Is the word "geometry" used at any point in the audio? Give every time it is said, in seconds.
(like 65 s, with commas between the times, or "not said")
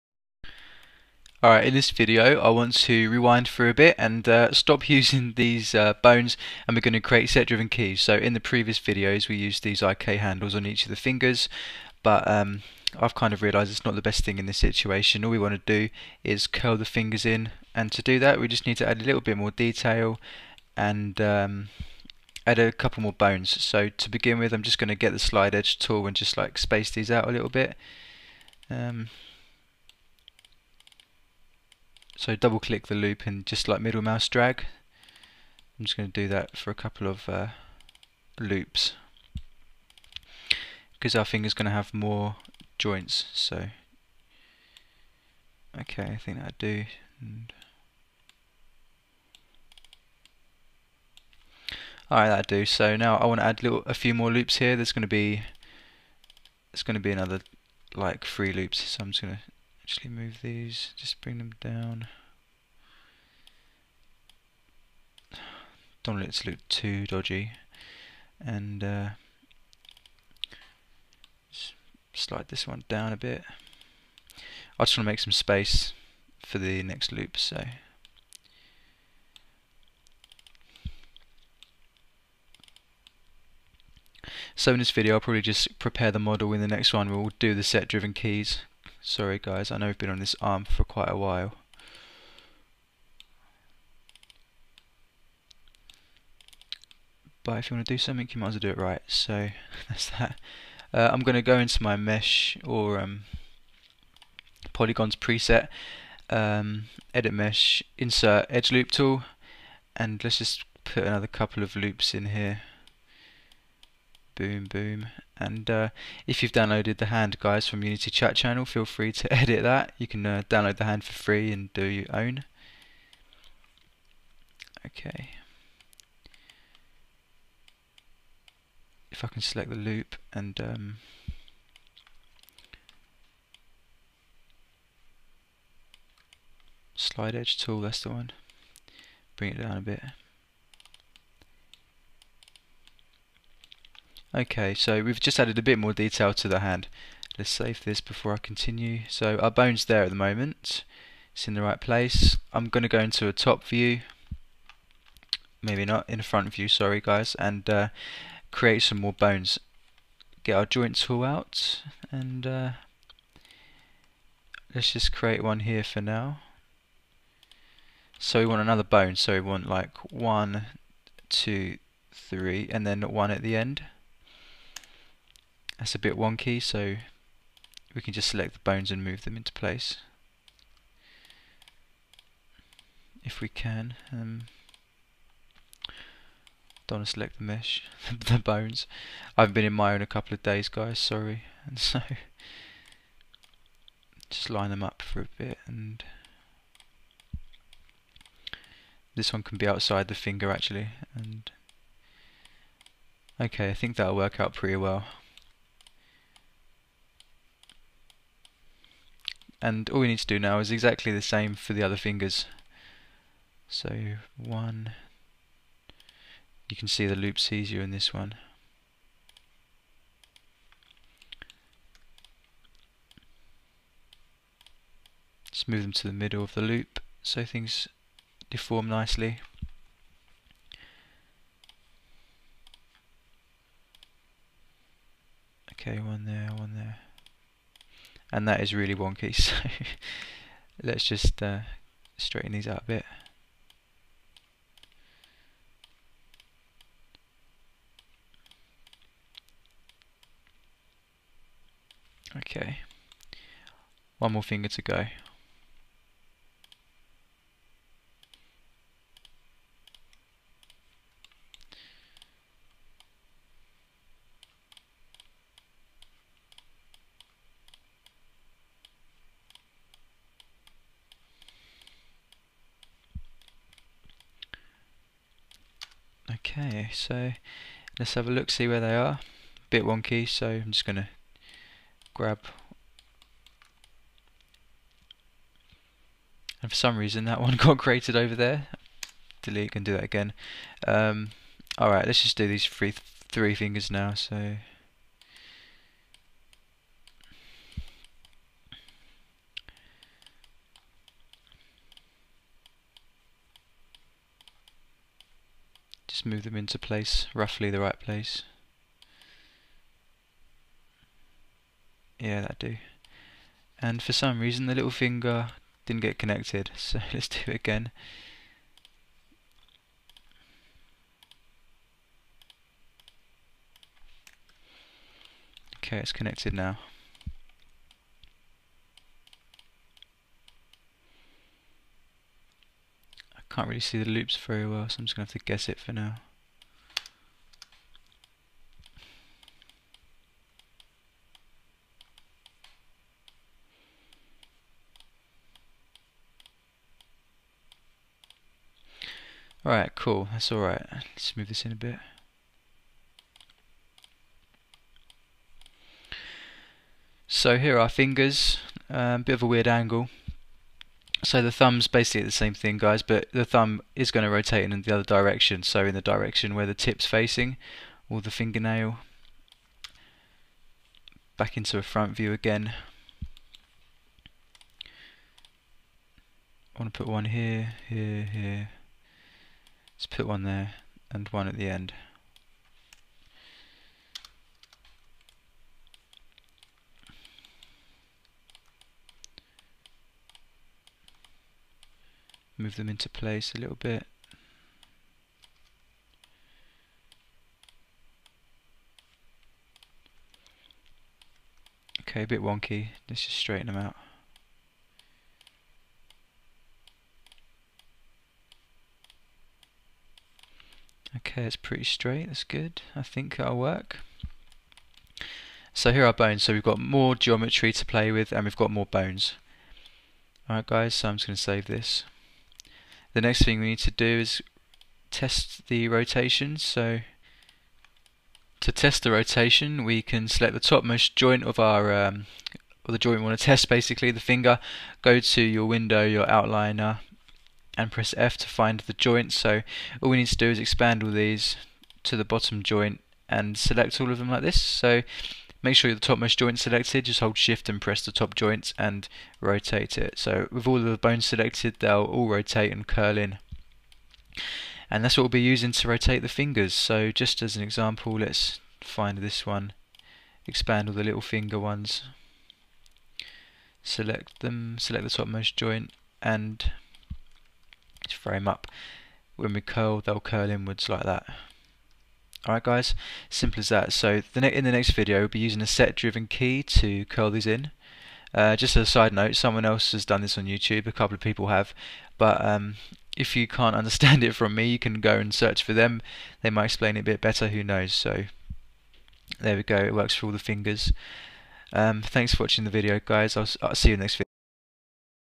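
417 s.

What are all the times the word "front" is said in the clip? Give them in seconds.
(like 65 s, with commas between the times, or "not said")
156 s, 371 s.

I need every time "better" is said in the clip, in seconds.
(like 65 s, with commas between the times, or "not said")
487 s.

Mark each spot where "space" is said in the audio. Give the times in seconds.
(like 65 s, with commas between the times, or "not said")
26 s, 75 s.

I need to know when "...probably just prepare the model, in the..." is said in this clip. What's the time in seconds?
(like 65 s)
85 s.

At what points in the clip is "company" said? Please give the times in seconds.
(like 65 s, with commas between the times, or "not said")
not said.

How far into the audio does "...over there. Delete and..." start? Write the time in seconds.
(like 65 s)
288 s.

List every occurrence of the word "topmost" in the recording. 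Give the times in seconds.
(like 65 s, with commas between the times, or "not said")
430 s, 445 s, 465 s.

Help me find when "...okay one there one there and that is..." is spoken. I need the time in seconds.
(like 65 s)
235 s.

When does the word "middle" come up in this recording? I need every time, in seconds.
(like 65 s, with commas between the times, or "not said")
33 s, 226 s.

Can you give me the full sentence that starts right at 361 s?
So the thumb's basically the same thing, guys, but the thumb is going to rotate in the other direction.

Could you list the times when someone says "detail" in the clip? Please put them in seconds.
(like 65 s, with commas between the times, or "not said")
19 s, 145 s.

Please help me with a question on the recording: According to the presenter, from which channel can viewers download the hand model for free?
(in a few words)
Unity Chat Channel.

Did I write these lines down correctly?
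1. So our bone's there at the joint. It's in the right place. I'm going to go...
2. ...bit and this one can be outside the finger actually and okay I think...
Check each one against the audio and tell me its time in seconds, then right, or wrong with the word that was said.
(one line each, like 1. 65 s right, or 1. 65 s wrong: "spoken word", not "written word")
1. 149 s wrong: "moment", not "joint"
2. 195 s right.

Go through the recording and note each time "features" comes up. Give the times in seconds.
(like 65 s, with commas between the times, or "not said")
not said.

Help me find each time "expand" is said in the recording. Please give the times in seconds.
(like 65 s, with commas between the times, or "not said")
440 s, 460 s.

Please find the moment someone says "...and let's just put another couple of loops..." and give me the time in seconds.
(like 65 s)
109 s.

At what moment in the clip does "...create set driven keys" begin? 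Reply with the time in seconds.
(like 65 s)
6 s.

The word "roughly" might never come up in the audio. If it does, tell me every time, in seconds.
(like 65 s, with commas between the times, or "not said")
307 s.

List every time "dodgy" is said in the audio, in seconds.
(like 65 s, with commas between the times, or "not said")
67 s.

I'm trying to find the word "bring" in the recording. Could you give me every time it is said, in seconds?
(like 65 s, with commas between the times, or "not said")
61 s, 139 s.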